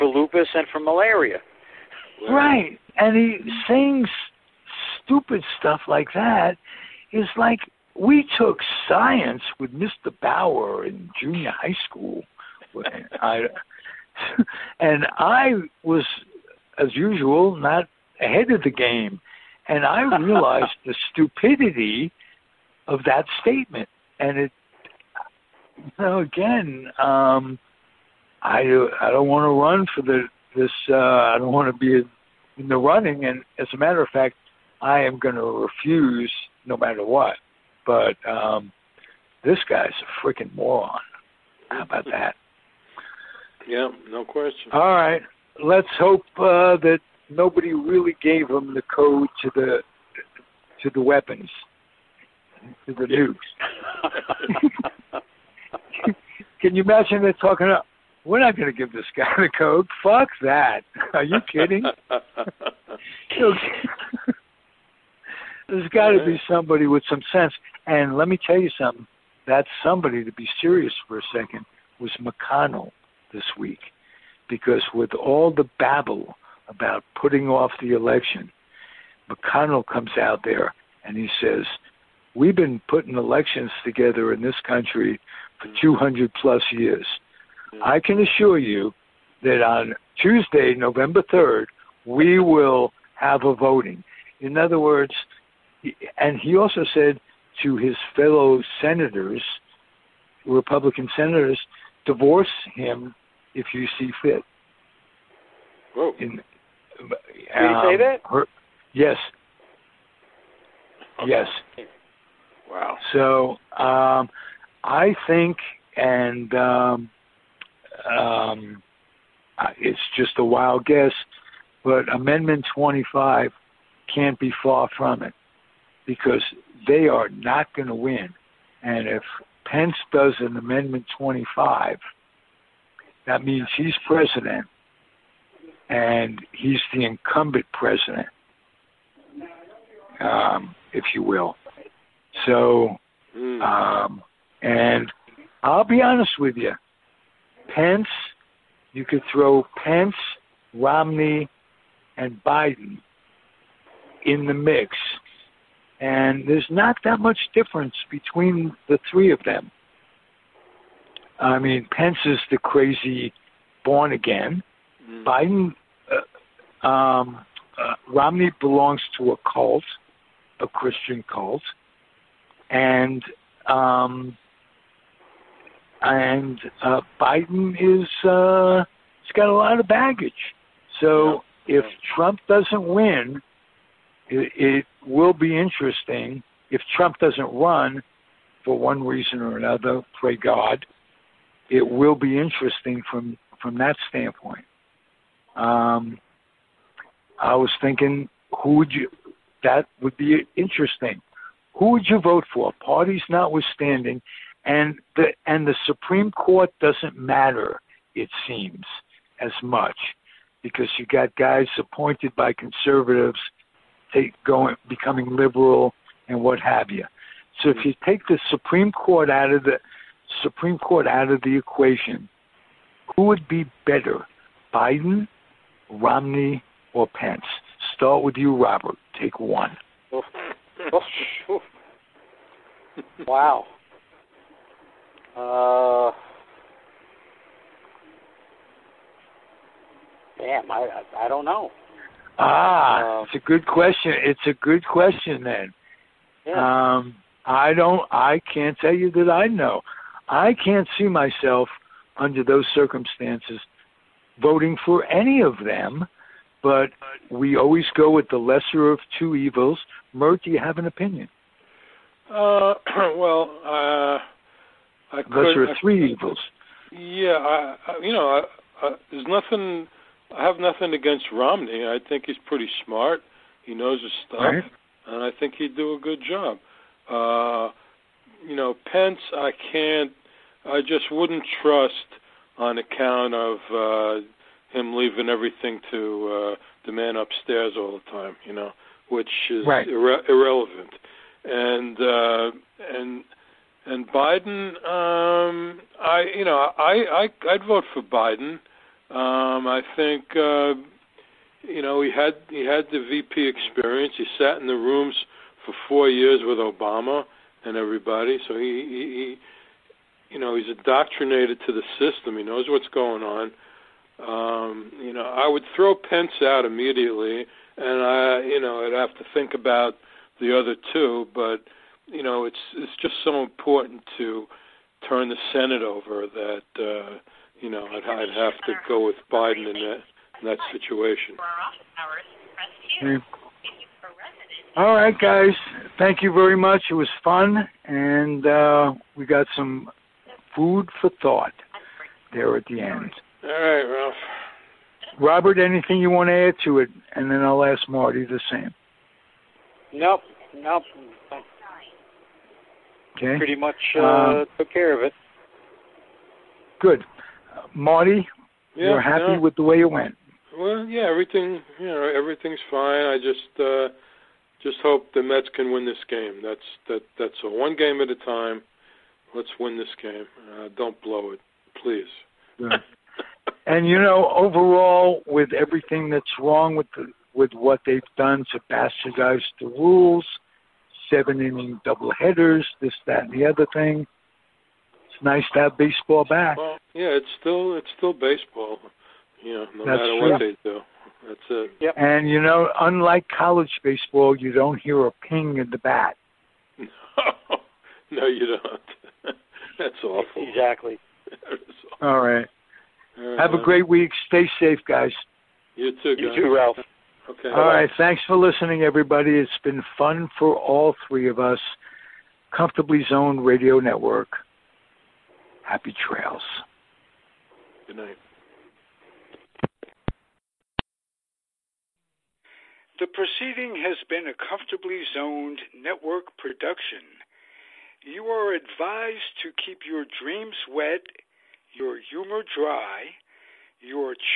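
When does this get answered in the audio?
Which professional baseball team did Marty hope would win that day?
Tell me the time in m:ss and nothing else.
6:05.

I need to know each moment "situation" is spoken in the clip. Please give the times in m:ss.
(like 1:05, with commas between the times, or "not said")
5:30.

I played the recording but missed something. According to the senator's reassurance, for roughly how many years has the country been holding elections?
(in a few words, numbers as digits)
200.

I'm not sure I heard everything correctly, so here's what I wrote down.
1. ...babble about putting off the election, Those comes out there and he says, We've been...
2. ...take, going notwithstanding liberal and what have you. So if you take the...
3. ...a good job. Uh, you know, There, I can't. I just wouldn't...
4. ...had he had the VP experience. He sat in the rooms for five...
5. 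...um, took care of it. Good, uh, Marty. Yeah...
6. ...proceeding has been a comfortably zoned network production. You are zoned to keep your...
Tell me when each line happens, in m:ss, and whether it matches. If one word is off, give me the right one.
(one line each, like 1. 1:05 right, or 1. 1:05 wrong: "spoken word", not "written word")
1. 1:15 wrong: "McConnell", not "Those"
2. 3:34 wrong: "becoming", not "notwithstanding"
3. 4:35 wrong: "Pence", not "There"
4. 5:02 wrong: "four", not "five"
5. 5:54 right
6. 7:03 wrong: "advised", not "zoned".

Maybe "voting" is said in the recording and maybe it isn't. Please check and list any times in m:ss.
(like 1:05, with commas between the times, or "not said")
1:33, 4:14.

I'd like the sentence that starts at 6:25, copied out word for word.
It's nice to have baseball back.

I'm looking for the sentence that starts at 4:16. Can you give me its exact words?
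But we always go with the lesser of two evils.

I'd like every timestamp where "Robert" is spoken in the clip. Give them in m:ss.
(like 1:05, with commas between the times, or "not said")
3:48, 5:45.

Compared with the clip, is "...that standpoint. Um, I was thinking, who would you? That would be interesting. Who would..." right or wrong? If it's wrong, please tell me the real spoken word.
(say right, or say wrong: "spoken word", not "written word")
right.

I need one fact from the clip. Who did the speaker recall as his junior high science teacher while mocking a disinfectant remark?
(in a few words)
Mr. Bauer.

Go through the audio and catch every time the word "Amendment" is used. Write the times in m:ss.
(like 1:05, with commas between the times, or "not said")
2:02, 2:10.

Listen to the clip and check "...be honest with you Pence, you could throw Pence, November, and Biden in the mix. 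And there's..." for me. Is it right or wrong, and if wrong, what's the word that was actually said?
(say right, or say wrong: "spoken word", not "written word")
wrong: "Romney", not "November".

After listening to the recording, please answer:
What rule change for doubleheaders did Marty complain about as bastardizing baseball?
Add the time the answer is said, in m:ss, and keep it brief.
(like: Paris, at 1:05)
seven inning double headers, at 6:21.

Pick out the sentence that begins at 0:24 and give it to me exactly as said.
And it know, again, um, I I don't want to run for the this.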